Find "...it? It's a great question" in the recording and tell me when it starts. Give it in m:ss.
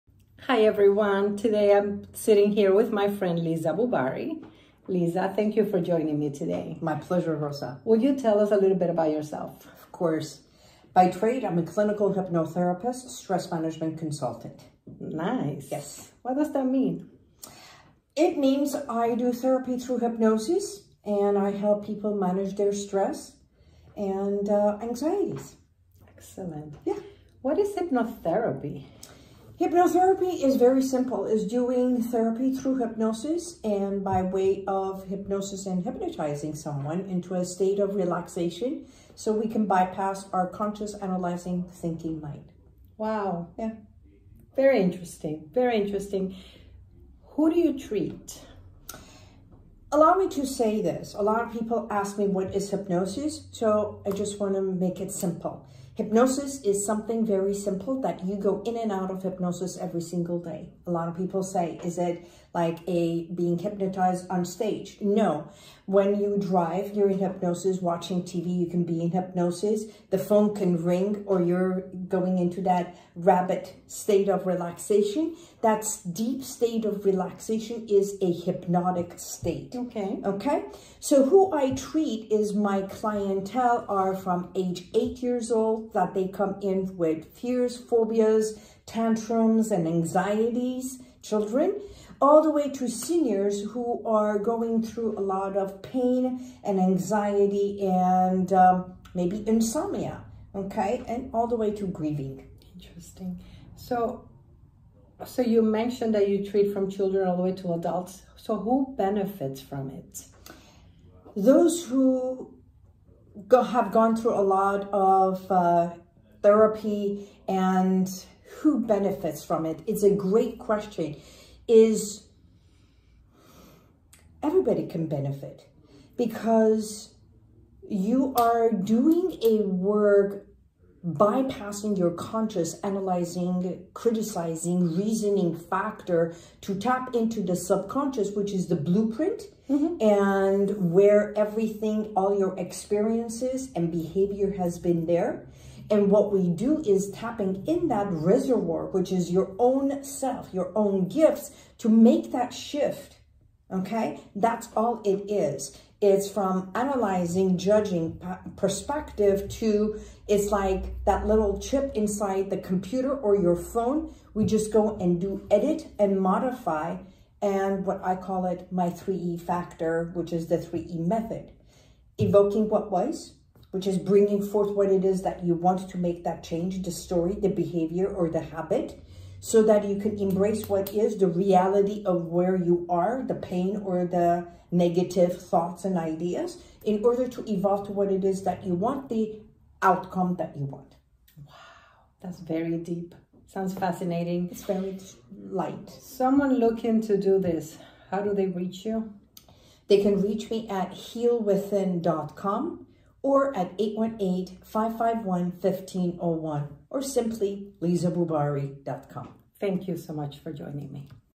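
1:59.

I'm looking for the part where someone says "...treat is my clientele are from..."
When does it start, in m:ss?
1:21.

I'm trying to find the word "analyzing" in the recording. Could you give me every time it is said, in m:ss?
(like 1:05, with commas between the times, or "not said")
0:40, 2:12, 2:36.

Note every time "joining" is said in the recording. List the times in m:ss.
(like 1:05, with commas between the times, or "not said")
0:05, 3:30.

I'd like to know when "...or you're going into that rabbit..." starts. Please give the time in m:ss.
1:11.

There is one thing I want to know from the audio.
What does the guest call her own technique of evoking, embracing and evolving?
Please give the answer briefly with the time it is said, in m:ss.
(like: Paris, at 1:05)
The 3E method, at 2:50.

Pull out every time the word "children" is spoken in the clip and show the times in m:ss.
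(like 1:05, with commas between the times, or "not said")
1:31, 1:46.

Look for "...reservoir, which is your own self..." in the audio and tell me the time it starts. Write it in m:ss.
2:28.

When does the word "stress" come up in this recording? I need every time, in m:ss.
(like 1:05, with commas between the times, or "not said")
0:13, 0:22.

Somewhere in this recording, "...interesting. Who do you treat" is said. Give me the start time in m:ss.
0:45.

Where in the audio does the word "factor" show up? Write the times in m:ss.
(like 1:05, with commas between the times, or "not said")
2:15, 2:49.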